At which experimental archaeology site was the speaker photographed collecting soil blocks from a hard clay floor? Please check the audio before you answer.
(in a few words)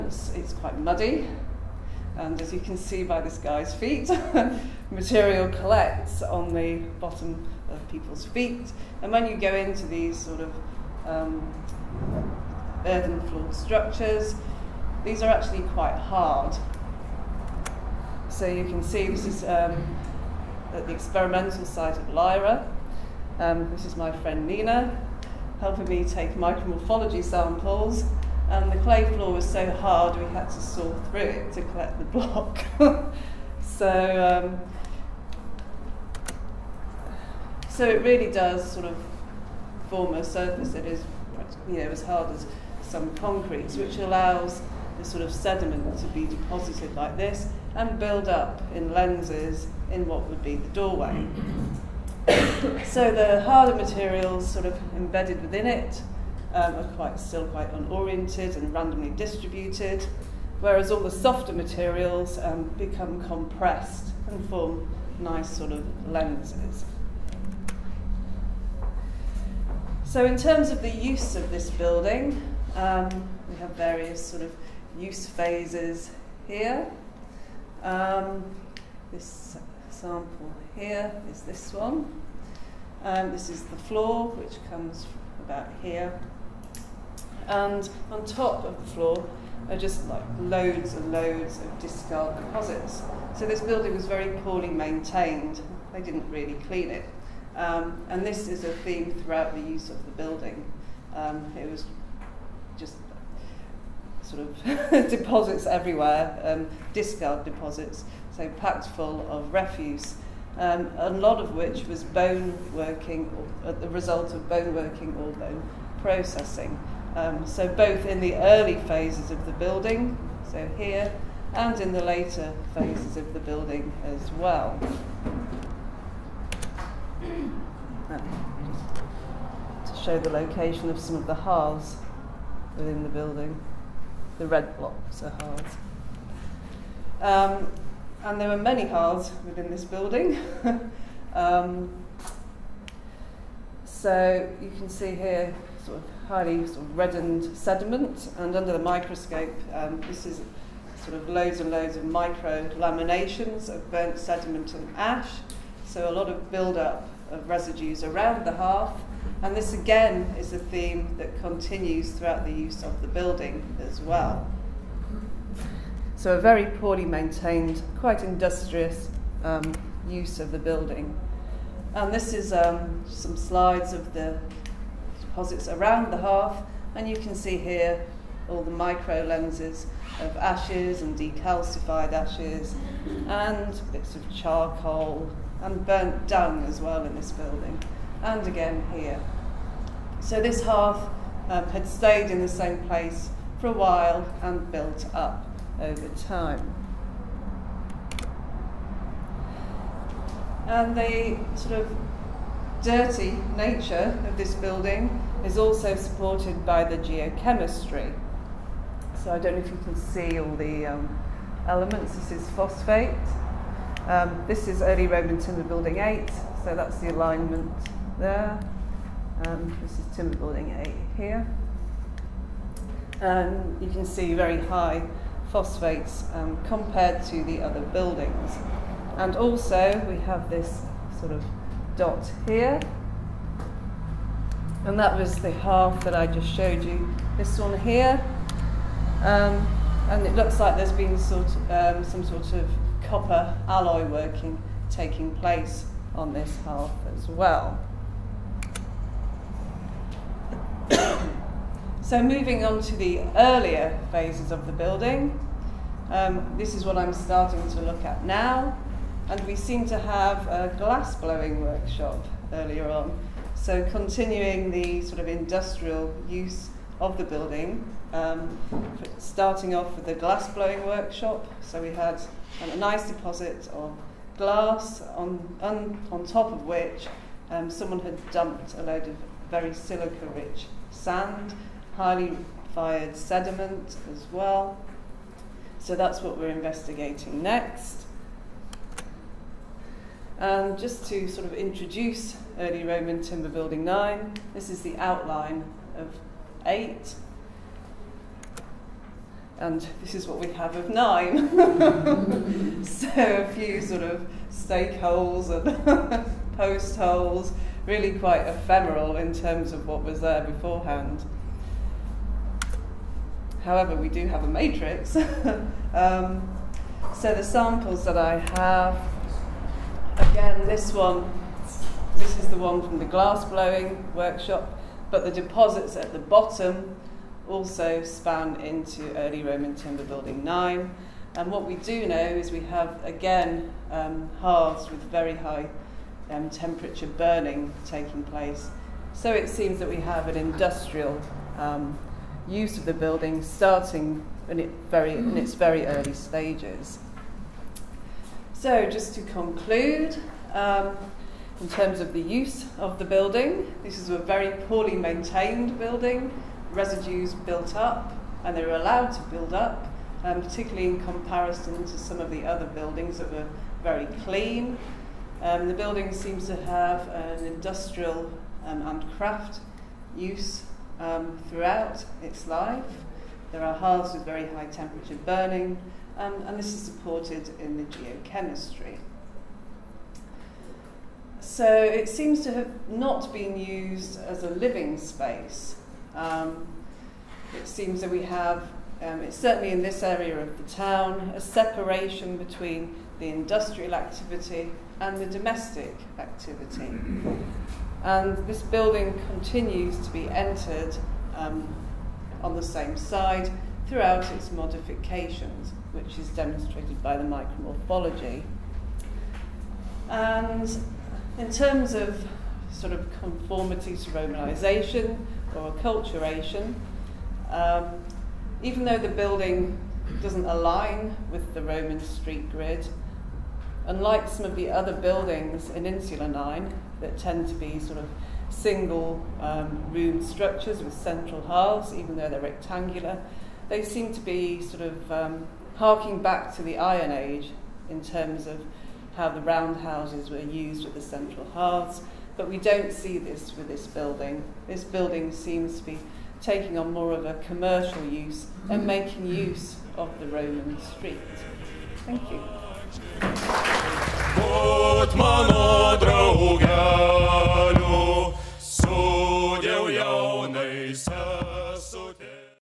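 Lejre.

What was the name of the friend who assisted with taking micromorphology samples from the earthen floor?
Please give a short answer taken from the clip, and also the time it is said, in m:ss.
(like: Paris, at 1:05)
Nina, at 0:24.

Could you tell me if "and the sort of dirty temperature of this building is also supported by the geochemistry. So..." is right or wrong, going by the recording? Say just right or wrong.
wrong.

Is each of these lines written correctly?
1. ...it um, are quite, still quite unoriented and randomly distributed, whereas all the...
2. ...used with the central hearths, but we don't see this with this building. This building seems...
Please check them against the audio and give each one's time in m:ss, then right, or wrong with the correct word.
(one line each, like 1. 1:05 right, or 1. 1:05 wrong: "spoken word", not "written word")
1. 0:55 right
2. 7:20 right.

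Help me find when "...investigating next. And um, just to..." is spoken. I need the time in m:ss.
4:46.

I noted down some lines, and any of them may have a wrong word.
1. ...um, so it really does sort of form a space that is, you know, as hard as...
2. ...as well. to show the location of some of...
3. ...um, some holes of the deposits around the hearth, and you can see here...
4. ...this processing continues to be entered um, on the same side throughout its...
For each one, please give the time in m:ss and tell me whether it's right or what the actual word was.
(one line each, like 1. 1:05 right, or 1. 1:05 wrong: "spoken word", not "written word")
1. 0:34 wrong: "surface", not "space"
2. 2:04 right
3. 2:52 wrong: "slides", not "holes"
4. 6:38 wrong: "building", not "processing".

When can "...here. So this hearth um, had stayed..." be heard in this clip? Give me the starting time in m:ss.
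3:08.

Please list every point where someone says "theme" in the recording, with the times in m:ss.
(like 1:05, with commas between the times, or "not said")
1:38, 2:40.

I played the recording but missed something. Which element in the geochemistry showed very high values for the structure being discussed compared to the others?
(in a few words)
Phosphate.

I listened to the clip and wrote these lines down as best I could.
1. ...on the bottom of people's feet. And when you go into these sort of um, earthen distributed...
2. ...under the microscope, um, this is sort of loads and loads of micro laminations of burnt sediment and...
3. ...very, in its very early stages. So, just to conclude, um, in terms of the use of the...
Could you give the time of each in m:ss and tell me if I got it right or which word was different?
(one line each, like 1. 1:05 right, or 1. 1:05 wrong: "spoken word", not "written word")
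1. 0:06 wrong: "floored", not "distributed"
2. 2:28 right
3. 5:44 right.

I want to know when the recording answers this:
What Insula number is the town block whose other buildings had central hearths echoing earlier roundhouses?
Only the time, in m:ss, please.
7:05.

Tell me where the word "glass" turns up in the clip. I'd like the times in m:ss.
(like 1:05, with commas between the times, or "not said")
4:20, 4:30, 4:34, 5:23.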